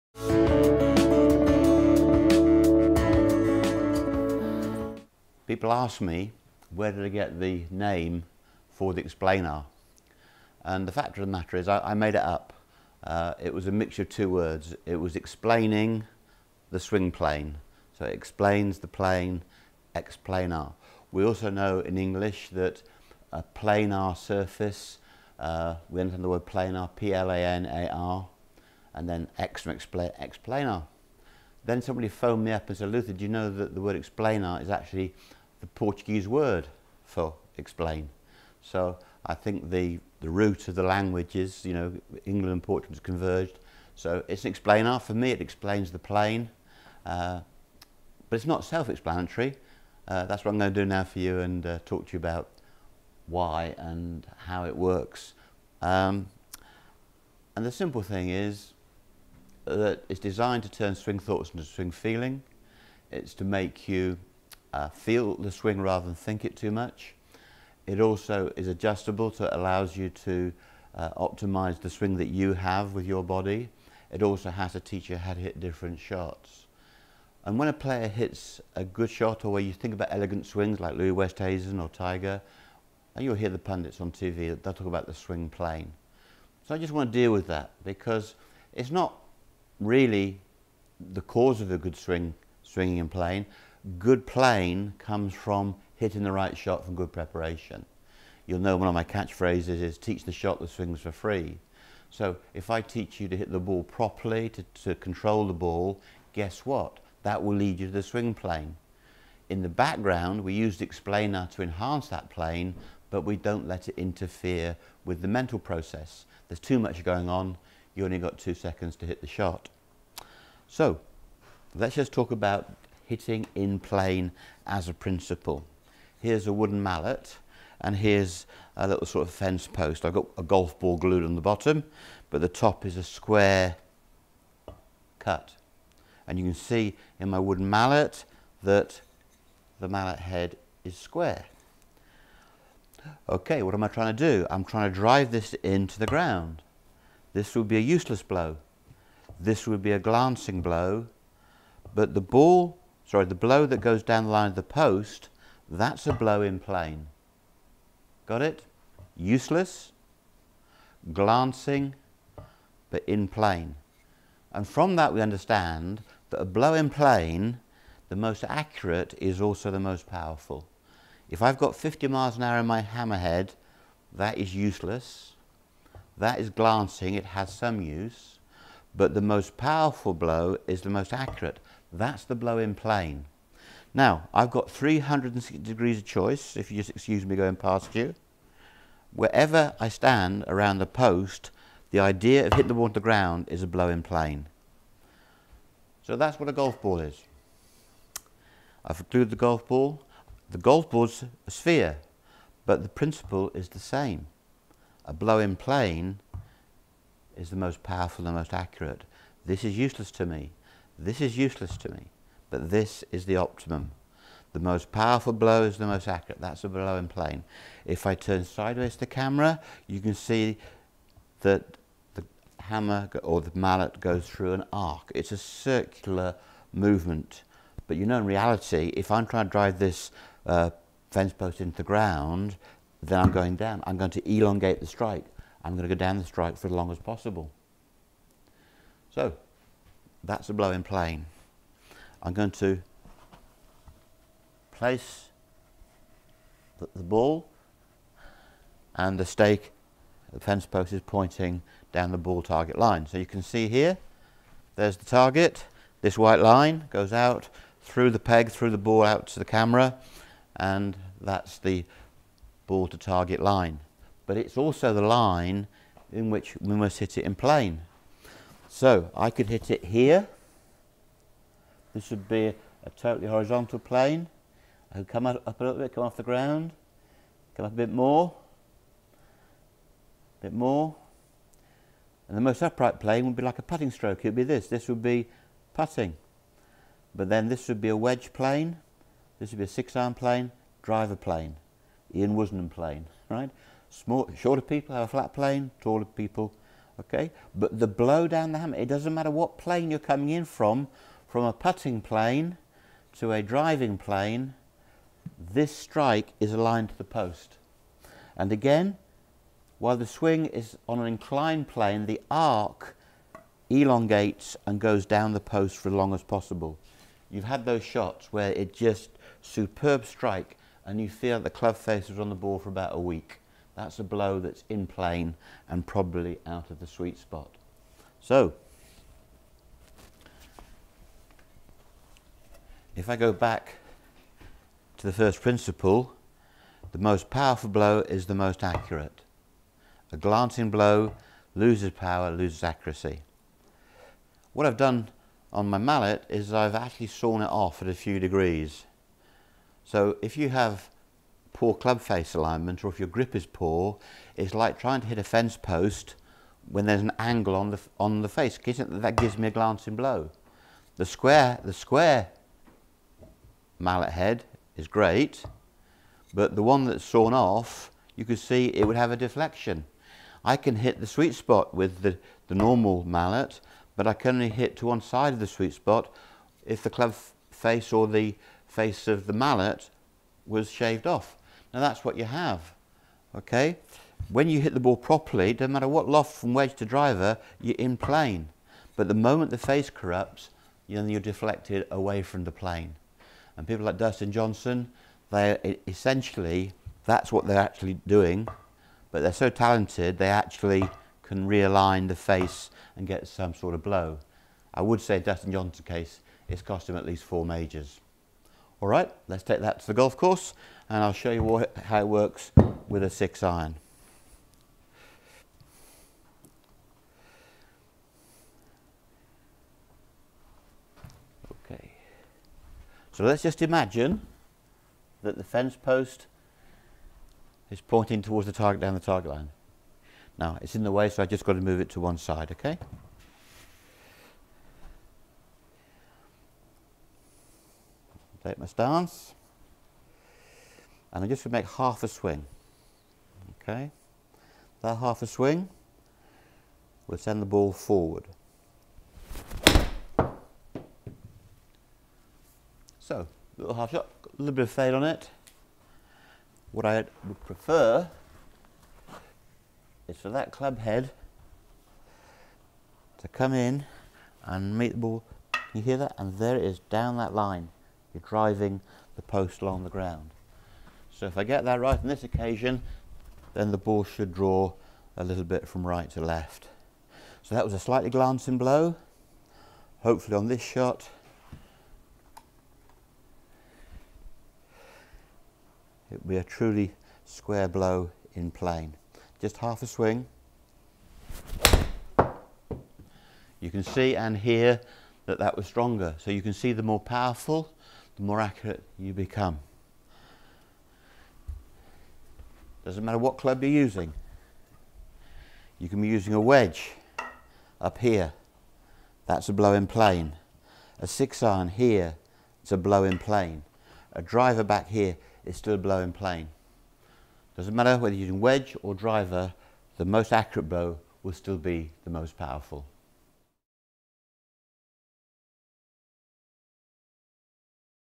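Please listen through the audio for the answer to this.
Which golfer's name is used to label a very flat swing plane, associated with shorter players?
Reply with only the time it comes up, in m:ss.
4:52.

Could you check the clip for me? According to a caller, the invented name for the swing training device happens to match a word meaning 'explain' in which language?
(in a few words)
Portuguese.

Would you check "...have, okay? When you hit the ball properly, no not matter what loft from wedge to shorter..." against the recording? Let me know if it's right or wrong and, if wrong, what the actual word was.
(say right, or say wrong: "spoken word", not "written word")
wrong: "driver", not "shorter".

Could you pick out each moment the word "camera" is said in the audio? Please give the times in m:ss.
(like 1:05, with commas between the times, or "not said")
3:39, 4:19.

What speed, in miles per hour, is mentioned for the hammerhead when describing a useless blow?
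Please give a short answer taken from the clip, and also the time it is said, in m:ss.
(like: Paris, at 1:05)
50, at 2:51.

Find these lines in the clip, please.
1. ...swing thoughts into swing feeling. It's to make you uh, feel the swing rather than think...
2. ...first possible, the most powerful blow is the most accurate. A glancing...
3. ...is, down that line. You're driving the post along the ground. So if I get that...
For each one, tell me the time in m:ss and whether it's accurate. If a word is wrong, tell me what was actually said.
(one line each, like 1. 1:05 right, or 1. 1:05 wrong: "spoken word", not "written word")
1. 1:00 right
2. 5:35 wrong: "principle", not "possible"
3. 7:46 right.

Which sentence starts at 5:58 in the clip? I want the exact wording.
That gives me a glancing blow.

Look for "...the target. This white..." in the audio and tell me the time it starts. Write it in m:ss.
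4:14.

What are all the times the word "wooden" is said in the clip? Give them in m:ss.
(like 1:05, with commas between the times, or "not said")
2:06, 2:17.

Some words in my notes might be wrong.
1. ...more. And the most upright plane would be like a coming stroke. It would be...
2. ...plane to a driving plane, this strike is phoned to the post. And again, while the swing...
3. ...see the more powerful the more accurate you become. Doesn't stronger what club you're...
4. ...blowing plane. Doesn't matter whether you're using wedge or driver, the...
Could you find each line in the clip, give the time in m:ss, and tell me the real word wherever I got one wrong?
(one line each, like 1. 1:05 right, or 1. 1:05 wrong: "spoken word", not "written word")
1. 4:40 wrong: "putting", not "coming"
2. 5:02 wrong: "aligned", not "phoned"
3. 8:16 wrong: "matter", not "stronger"
4. 8:35 right.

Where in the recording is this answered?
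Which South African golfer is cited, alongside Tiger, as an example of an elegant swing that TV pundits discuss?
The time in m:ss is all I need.
1:20.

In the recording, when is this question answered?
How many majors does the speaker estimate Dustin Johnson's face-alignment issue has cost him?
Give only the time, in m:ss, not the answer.
6:47.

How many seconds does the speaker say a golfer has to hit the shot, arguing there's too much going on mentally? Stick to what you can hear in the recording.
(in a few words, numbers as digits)
2.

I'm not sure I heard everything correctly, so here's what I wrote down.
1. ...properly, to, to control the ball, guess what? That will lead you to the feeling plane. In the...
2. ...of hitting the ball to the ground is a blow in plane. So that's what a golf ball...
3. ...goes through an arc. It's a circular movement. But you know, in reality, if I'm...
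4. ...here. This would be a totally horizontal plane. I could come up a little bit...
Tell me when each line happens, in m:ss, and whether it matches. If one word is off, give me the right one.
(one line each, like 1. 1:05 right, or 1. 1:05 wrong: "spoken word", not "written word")
1. 1:43 wrong: "swing", not "feeling"
2. 3:12 right
3. 3:43 right
4. 4:29 right.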